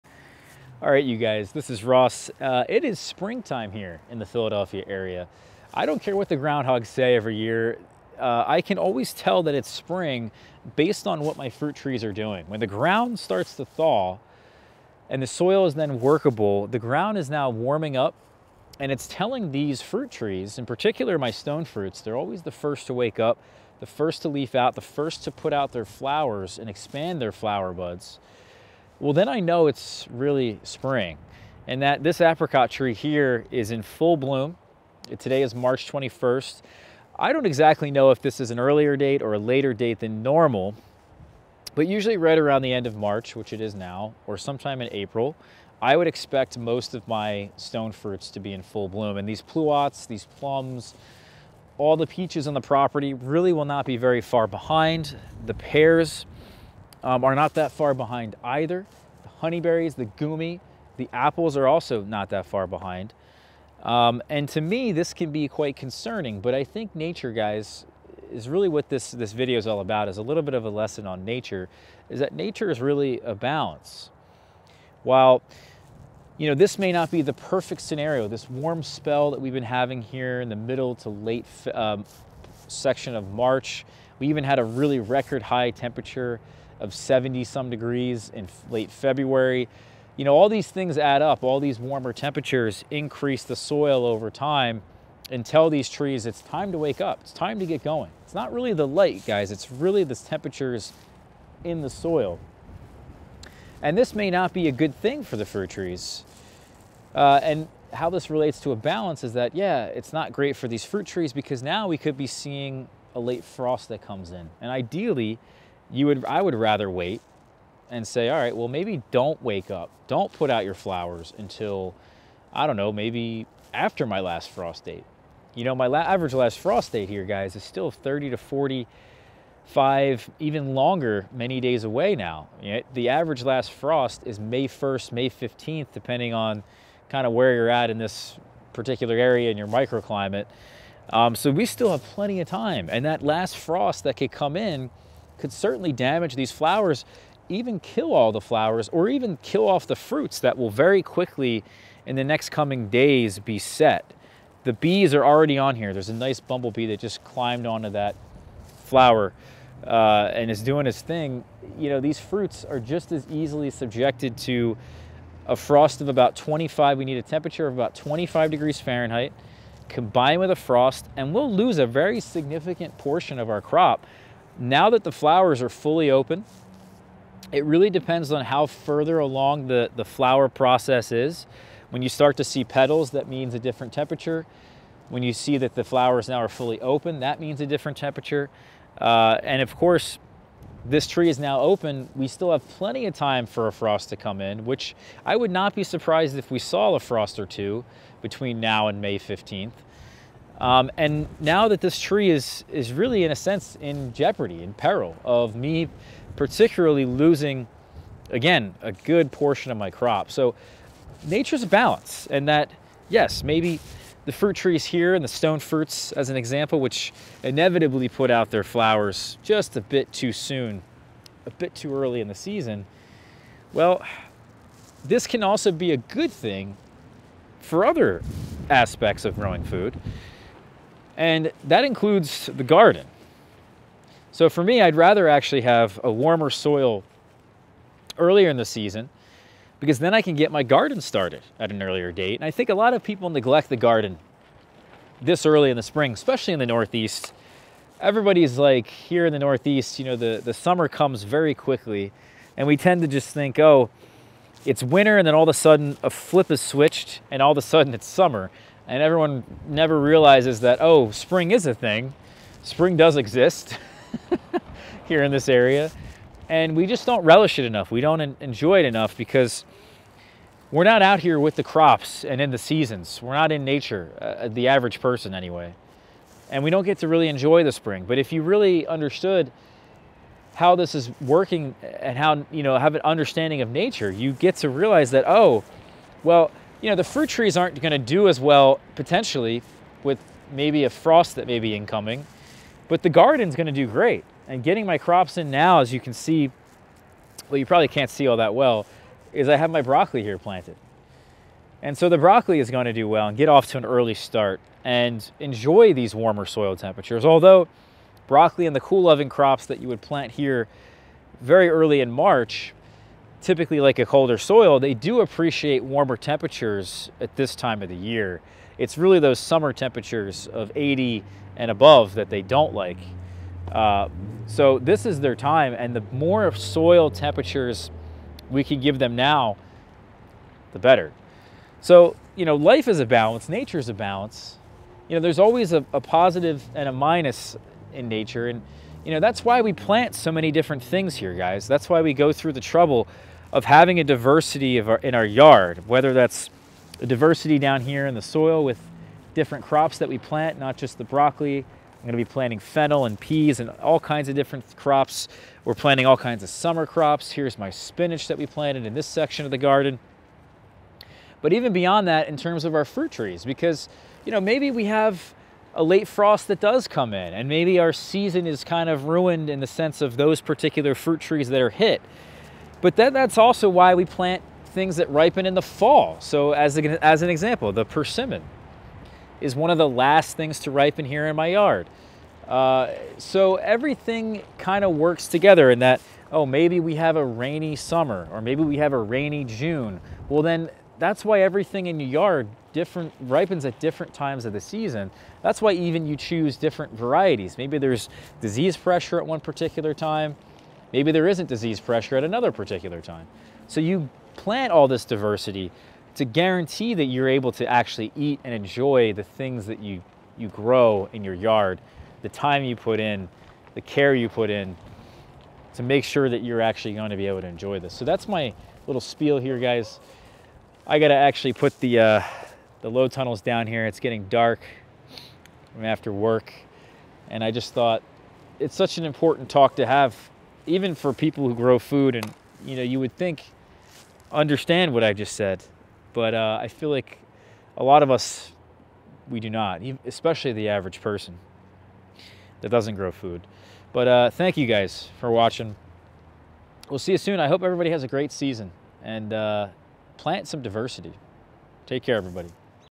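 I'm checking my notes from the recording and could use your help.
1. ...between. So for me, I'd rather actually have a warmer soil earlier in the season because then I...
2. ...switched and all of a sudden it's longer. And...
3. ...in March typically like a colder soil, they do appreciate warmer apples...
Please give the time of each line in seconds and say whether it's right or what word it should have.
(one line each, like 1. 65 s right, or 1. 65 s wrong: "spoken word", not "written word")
1. 232 s wrong: "garden", not "between"
2. 256 s wrong: "summer", not "longer"
3. 312 s wrong: "temperatures", not "apples".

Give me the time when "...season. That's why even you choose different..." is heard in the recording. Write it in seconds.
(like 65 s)
394 s.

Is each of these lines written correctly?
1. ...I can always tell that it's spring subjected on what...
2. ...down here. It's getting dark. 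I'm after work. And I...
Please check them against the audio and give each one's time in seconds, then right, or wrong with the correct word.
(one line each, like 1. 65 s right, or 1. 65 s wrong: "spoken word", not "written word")
1. 8 s wrong: "based", not "subjected"
2. 423 s right.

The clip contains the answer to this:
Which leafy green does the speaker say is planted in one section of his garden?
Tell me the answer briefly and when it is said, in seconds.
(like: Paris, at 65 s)
Spinach, at 357 s.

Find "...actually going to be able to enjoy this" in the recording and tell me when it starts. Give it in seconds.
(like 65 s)
416 s.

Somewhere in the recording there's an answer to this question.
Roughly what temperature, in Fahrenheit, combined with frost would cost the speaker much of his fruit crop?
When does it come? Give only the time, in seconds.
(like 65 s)
167 s.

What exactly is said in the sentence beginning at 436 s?
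But uh, I feel like a lot of us, we do not, especially the average person that doesn't grow food.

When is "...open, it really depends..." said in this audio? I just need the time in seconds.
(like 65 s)
176 s.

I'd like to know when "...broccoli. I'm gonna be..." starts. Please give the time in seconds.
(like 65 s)
351 s.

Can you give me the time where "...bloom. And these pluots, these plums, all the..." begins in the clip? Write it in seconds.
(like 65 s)
48 s.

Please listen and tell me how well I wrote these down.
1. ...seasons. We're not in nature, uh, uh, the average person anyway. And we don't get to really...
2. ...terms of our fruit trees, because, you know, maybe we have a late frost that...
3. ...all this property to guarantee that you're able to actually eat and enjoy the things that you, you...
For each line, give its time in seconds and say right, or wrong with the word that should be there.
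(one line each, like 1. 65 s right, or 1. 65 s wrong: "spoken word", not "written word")
1. 272 s right
2. 362 s right
3. 404 s wrong: "diversity", not "property".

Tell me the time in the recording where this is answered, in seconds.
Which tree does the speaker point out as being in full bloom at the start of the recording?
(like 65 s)
32 s.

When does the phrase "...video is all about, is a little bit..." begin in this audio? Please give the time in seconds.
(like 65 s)
69 s.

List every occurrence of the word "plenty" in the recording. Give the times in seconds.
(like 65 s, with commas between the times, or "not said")
142 s, 192 s.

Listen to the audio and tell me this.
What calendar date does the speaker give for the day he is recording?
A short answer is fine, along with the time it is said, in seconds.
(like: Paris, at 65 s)
March 21st, at 35 s.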